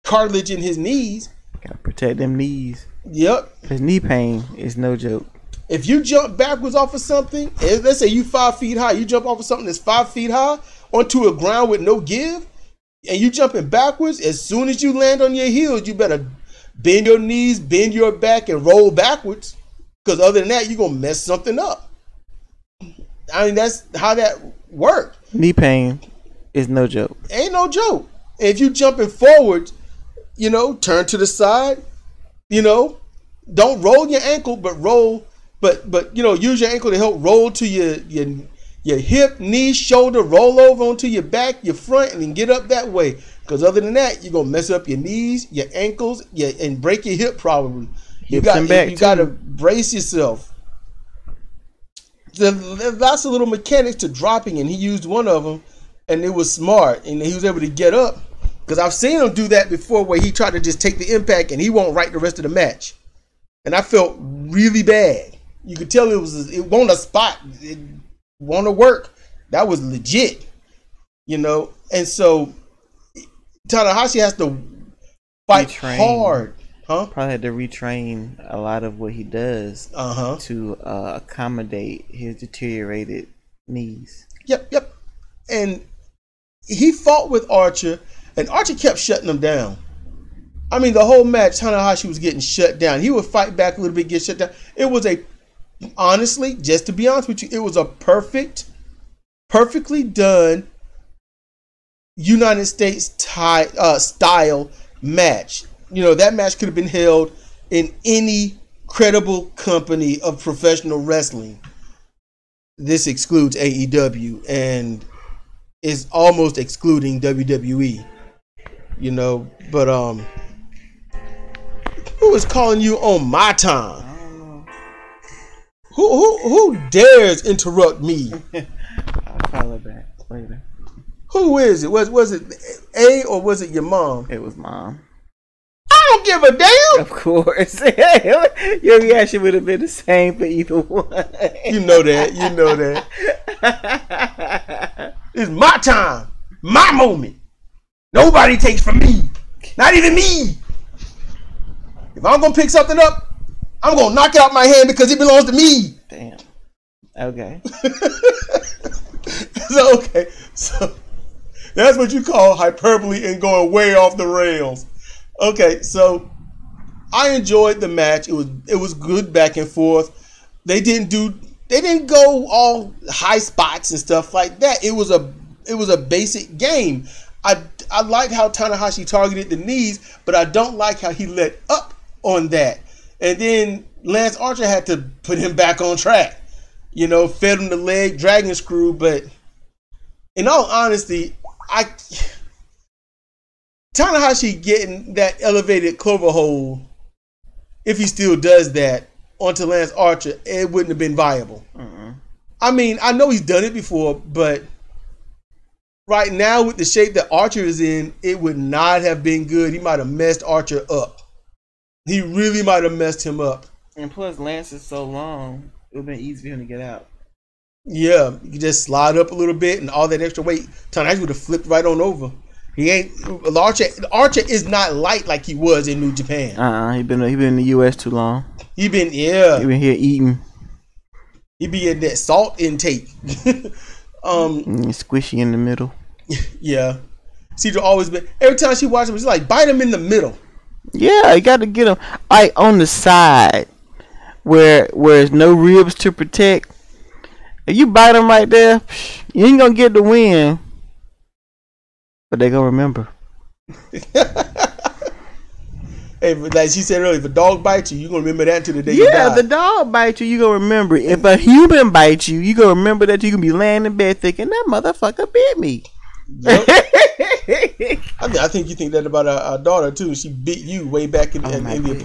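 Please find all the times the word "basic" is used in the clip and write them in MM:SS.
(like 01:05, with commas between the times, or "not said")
02:55.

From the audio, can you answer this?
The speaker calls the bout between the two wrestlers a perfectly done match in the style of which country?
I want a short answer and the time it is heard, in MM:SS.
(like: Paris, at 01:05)
United States, at 01:42.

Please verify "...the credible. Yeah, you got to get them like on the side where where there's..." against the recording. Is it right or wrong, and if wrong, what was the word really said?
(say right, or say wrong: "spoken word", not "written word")
wrong: "middle", not "credible".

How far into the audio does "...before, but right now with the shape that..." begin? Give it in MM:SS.
03:23.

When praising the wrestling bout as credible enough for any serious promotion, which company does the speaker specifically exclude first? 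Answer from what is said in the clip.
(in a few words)
AEW.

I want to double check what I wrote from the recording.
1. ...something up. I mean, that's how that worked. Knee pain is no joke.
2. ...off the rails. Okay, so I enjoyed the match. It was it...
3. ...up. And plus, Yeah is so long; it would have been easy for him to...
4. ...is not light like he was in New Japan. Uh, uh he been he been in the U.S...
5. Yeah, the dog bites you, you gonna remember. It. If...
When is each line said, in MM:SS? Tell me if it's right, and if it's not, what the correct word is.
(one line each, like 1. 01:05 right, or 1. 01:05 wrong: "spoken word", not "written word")
1. 00:21 right
2. 02:43 right
3. 03:33 wrong: "Lance", not "Yeah"
4. 03:44 right
5. 04:19 right.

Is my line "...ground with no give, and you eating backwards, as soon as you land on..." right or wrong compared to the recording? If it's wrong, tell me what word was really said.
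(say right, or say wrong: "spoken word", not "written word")
wrong: "jumping", not "eating".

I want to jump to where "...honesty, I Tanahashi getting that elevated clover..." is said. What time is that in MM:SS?
03:10.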